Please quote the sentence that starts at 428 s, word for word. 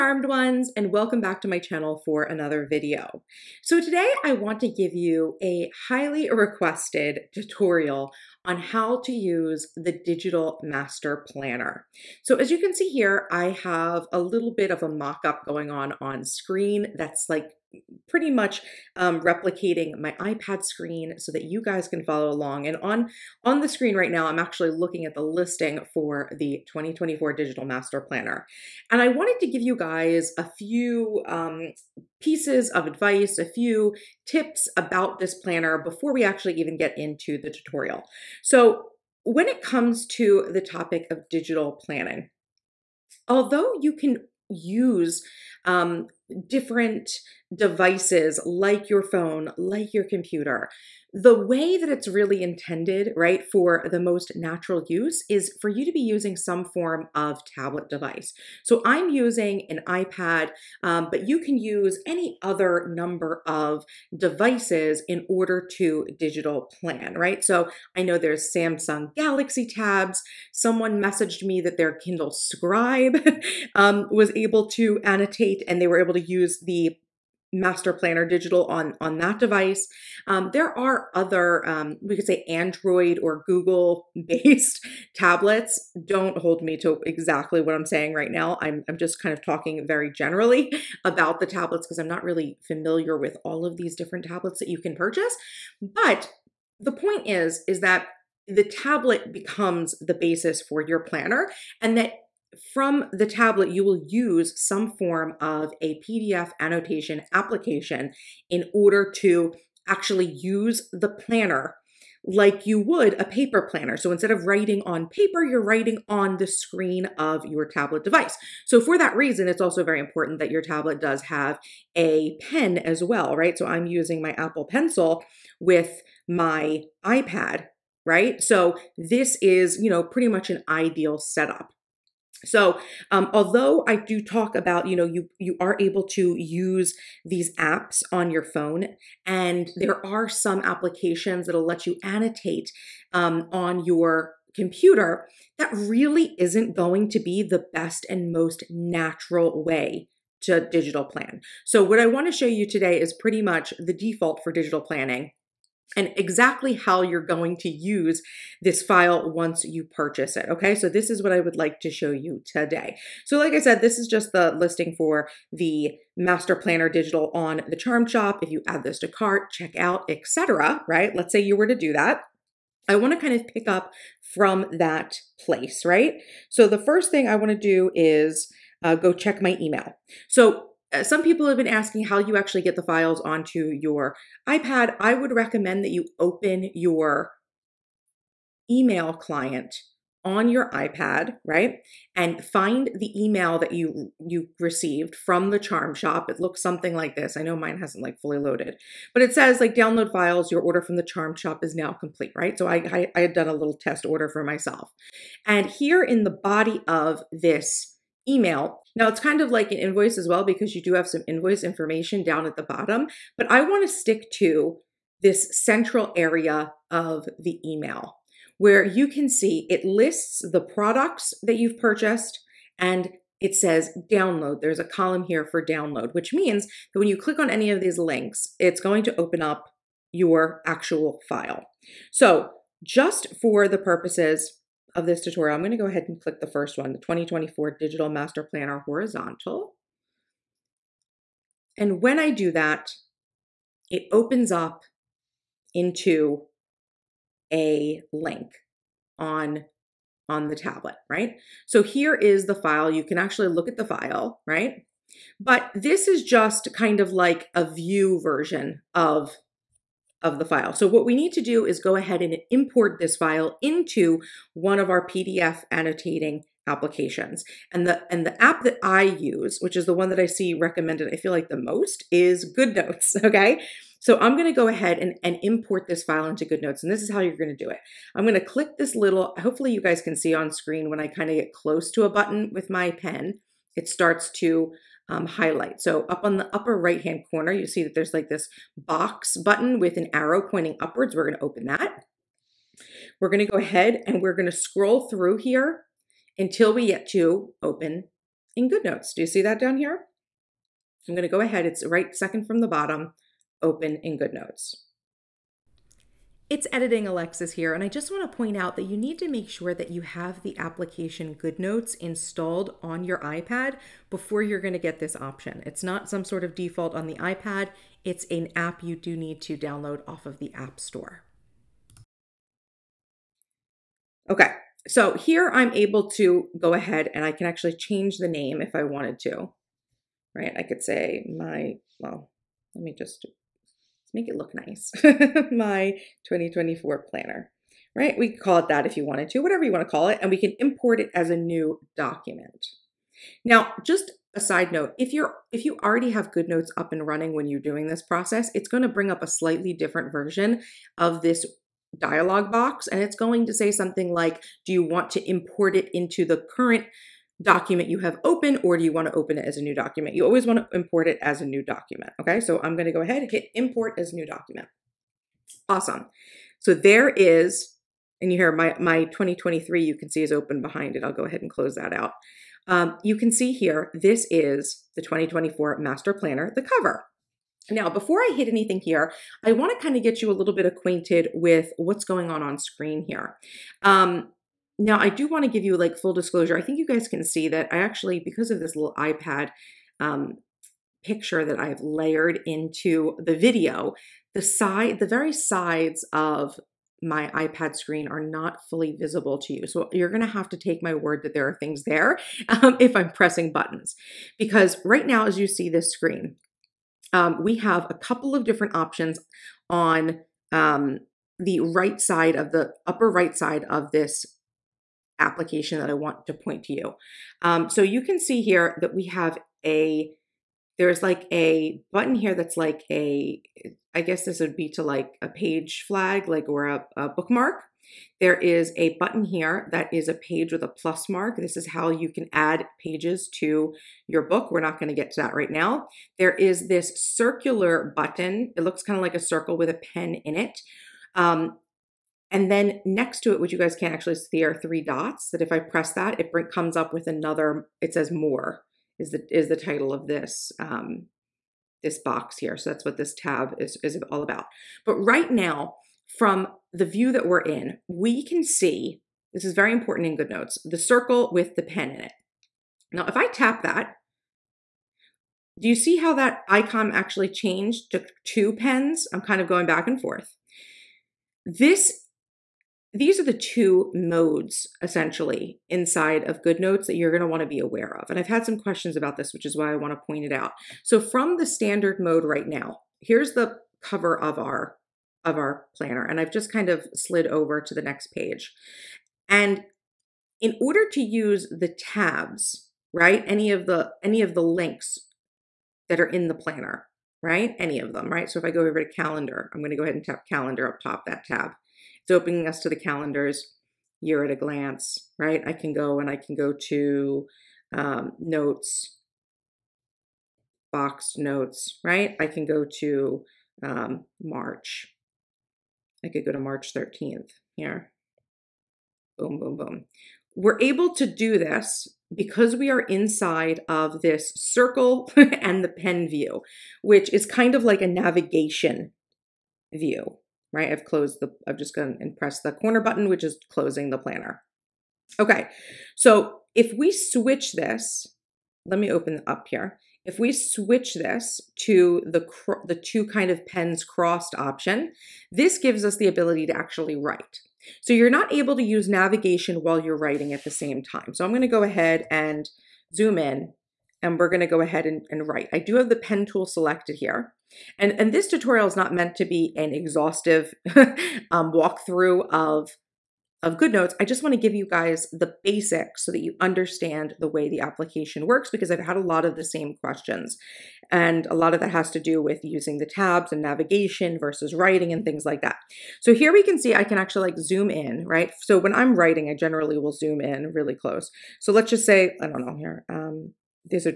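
There is a button here that is a page with a plus mark.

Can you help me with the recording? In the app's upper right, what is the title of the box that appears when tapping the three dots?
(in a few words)
More.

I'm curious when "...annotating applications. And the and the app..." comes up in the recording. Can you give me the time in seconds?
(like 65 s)
265 s.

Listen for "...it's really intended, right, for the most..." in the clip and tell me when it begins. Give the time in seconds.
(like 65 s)
51 s.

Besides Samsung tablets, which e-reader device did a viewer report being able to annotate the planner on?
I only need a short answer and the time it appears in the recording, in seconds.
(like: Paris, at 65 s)
Kindle Scribe, at 71 s.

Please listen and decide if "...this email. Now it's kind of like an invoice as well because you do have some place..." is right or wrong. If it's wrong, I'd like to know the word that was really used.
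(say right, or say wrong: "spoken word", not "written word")
wrong: "invoice", not "place".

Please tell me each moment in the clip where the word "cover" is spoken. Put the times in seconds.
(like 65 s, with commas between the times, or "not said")
376 s, 483 s.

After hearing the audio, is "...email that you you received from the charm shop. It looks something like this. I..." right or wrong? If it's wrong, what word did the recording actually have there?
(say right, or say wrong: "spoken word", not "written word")
right.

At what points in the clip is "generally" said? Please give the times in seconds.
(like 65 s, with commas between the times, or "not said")
90 s, 579 s.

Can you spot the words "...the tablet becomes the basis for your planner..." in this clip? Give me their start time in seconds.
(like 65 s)
98 s.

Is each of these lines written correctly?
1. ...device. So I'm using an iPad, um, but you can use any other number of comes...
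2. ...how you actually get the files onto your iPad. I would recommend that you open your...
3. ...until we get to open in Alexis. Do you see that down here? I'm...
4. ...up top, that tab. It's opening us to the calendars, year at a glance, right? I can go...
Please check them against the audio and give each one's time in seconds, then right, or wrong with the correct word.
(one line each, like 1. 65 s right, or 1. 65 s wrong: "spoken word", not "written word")
1. 57 s wrong: "devices", not "comes"
2. 182 s right
3. 296 s wrong: "GoodNotes", not "Alexis"
4. 500 s right.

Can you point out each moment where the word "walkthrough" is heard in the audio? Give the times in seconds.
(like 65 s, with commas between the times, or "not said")
561 s.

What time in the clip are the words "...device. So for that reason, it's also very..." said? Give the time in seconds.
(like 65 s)
118 s.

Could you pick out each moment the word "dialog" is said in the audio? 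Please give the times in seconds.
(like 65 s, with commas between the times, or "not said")
351 s.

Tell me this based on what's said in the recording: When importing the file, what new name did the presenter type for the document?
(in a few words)
My 2024 planner.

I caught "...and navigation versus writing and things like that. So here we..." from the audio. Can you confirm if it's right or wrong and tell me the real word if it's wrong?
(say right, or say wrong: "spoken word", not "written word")
right.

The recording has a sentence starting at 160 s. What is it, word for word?
Okay, so this is what I would like to show you today.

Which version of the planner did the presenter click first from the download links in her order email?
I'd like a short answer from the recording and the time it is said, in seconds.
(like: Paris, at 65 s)
Horizontal, at 238 s.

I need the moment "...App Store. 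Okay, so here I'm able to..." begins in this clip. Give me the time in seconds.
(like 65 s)
320 s.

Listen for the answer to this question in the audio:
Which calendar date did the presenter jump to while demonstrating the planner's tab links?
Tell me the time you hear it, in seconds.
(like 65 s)
516 s.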